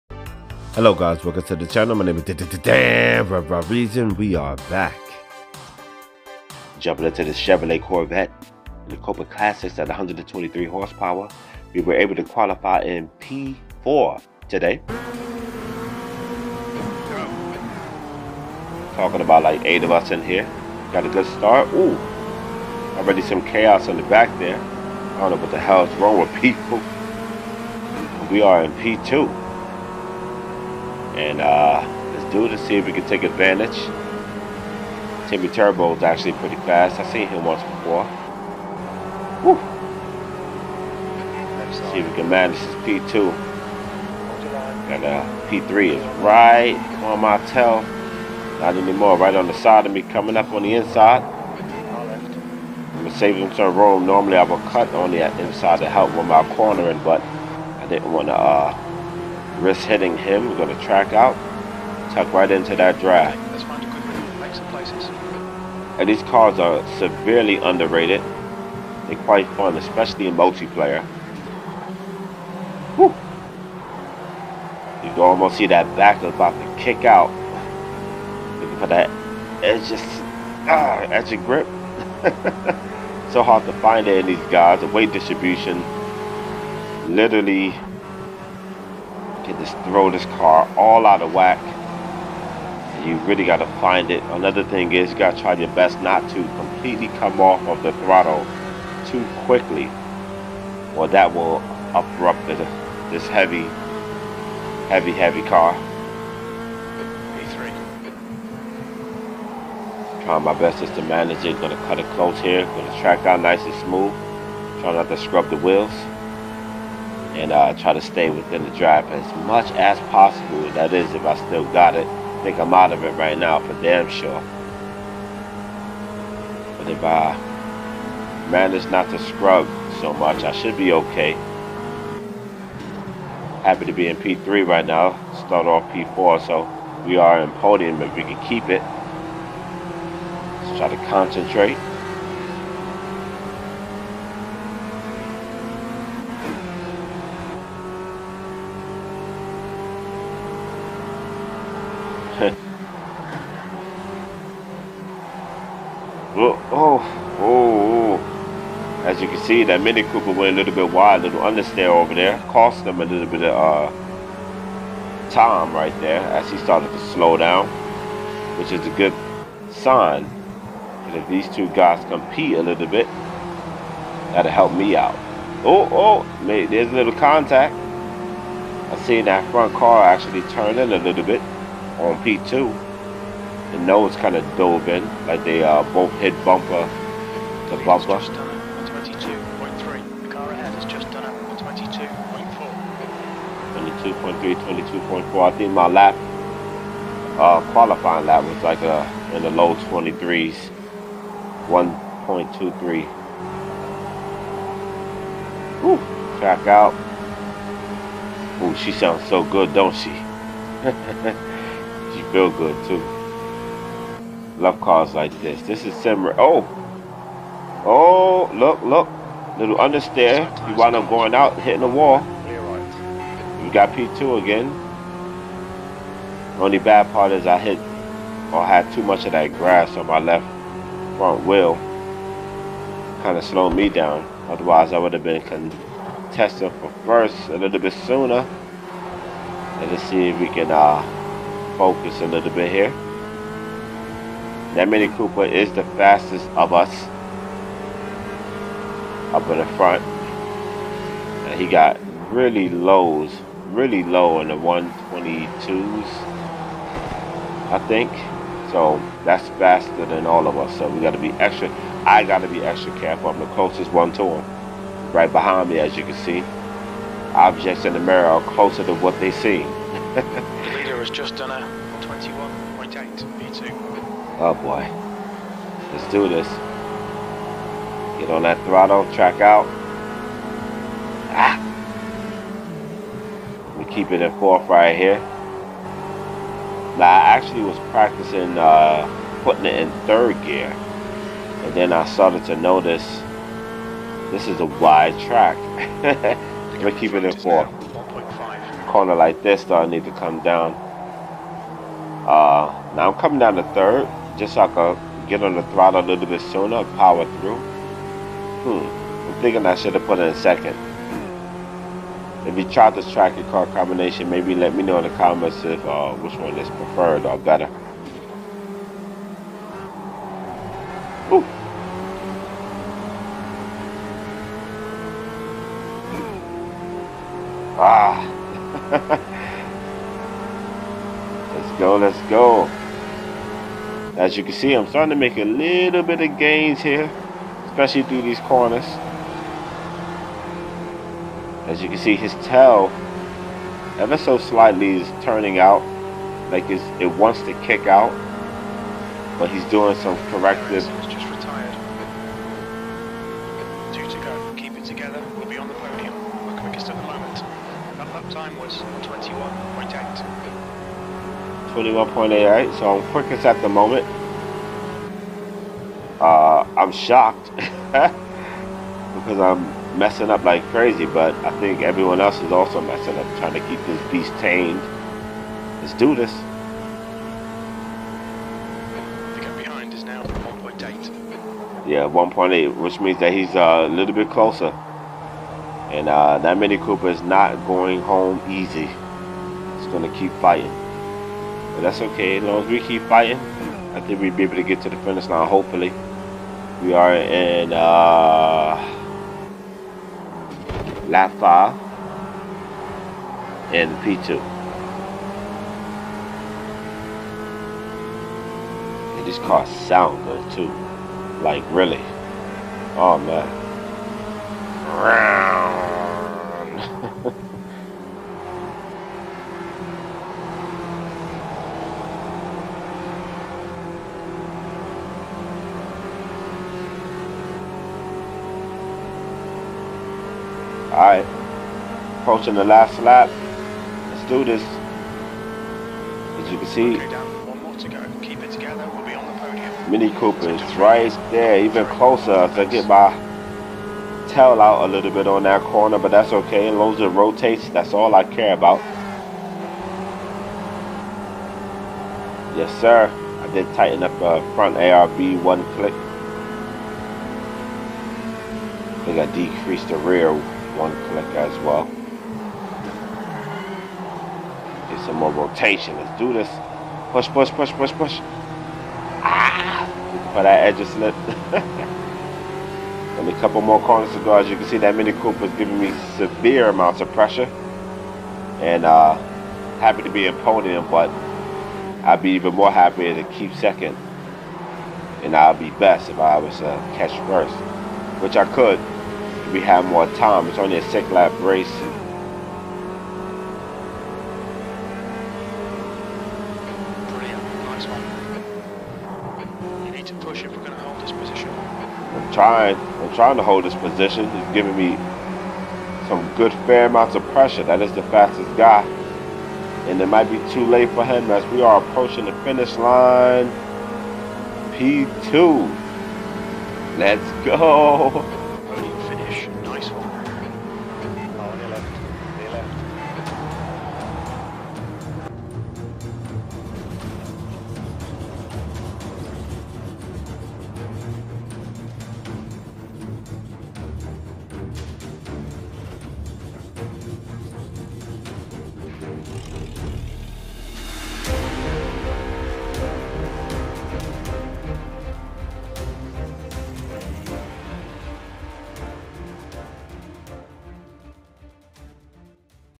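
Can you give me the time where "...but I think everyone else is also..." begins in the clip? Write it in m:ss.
6:11.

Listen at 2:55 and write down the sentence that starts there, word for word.
Oh, oh, there's a little contact.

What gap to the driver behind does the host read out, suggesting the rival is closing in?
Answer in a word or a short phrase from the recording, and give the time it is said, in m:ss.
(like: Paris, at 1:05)
1.8, at 6:19.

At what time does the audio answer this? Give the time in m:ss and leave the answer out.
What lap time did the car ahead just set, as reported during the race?
3:11.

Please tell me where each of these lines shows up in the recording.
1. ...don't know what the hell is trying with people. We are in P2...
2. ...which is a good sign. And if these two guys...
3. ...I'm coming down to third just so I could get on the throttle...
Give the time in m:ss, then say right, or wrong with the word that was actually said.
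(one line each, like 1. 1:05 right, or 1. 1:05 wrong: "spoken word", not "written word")
1. 0:25 wrong: "wrong", not "trying"
2. 2:48 right
3. 5:03 right.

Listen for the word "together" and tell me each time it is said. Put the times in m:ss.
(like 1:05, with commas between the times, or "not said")
7:18.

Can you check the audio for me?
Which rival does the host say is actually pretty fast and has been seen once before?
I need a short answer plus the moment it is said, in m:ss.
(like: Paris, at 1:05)
Timmy Turbo, at 0:35.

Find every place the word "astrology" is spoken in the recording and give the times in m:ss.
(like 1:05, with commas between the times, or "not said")
not said.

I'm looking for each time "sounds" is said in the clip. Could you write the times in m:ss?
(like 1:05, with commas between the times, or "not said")
3:28, 6:49.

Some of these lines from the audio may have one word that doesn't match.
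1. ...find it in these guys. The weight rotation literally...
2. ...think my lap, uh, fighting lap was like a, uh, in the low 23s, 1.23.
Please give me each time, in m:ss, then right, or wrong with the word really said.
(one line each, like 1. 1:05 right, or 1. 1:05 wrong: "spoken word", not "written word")
1. 1:23 wrong: "distribution", not "rotation"
2. 3:15 wrong: "qualifying", not "fighting".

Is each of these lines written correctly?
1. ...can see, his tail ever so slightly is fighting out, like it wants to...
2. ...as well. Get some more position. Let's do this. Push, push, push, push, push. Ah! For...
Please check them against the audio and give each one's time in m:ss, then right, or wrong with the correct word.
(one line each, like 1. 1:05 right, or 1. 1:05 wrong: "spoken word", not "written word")
1. 5:41 wrong: "turning", not "fighting"
2. 7:41 wrong: "rotation", not "position".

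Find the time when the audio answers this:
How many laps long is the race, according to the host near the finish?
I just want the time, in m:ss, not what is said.
8:10.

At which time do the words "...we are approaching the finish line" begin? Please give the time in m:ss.
8:31.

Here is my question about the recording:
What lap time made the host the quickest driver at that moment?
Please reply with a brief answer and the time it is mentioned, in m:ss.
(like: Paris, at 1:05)
21.88, at 6:01.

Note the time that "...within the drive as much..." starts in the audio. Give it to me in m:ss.
1:58.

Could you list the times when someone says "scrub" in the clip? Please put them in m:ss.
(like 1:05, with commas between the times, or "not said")
1:55, 2:09.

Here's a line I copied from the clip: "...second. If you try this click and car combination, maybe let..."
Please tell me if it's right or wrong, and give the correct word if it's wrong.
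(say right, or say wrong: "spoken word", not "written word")
wrong: "track", not "click".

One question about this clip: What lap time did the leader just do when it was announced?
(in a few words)
121.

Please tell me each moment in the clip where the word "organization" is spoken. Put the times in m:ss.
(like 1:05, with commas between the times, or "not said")
not said.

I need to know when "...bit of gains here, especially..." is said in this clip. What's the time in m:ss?
5:36.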